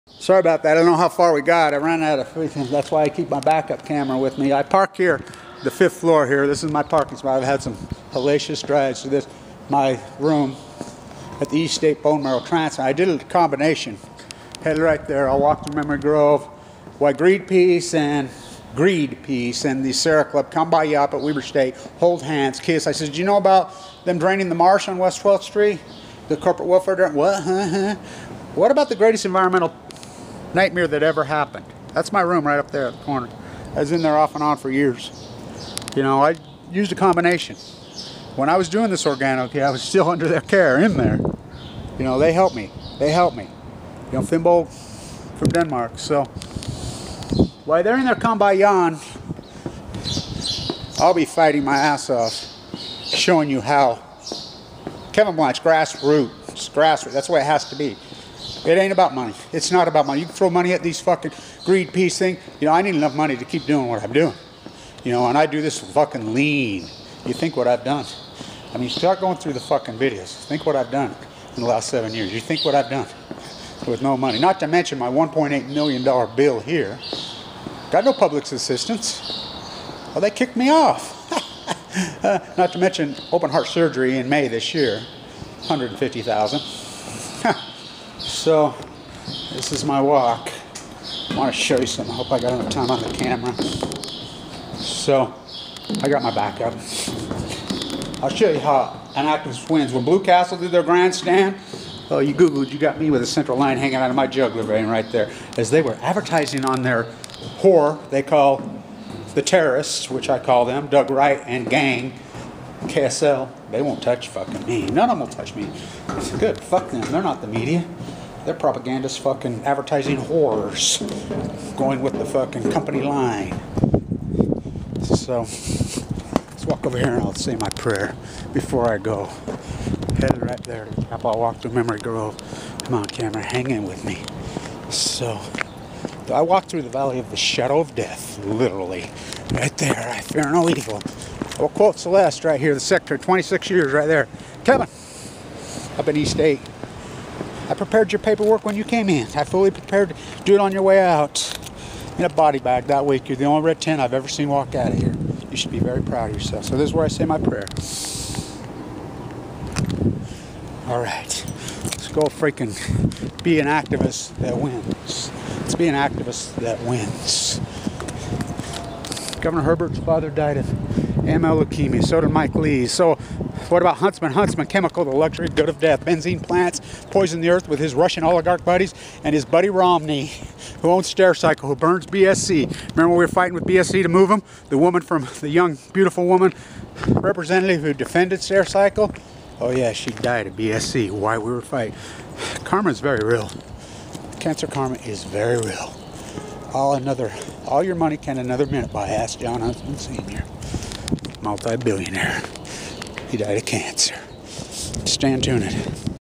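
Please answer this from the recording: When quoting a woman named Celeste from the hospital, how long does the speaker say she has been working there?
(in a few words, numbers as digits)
26 years.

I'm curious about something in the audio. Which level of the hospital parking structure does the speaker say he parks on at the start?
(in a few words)
Fifth floor.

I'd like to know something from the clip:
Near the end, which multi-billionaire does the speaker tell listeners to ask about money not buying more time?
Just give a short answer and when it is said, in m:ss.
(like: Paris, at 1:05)
Jon Huntsman Sr., at 3:19.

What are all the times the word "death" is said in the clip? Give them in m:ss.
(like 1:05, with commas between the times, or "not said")
2:17, 2:55.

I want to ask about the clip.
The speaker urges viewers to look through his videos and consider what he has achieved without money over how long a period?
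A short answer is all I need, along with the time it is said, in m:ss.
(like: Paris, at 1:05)
7 years, at 1:11.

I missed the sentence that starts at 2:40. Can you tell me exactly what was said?
All right, let's go freaking be an activist that wins.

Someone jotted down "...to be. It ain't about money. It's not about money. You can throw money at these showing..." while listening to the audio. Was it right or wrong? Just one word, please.
wrong.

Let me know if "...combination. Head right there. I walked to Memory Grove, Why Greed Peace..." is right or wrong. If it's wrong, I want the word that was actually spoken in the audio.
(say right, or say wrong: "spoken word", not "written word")
right.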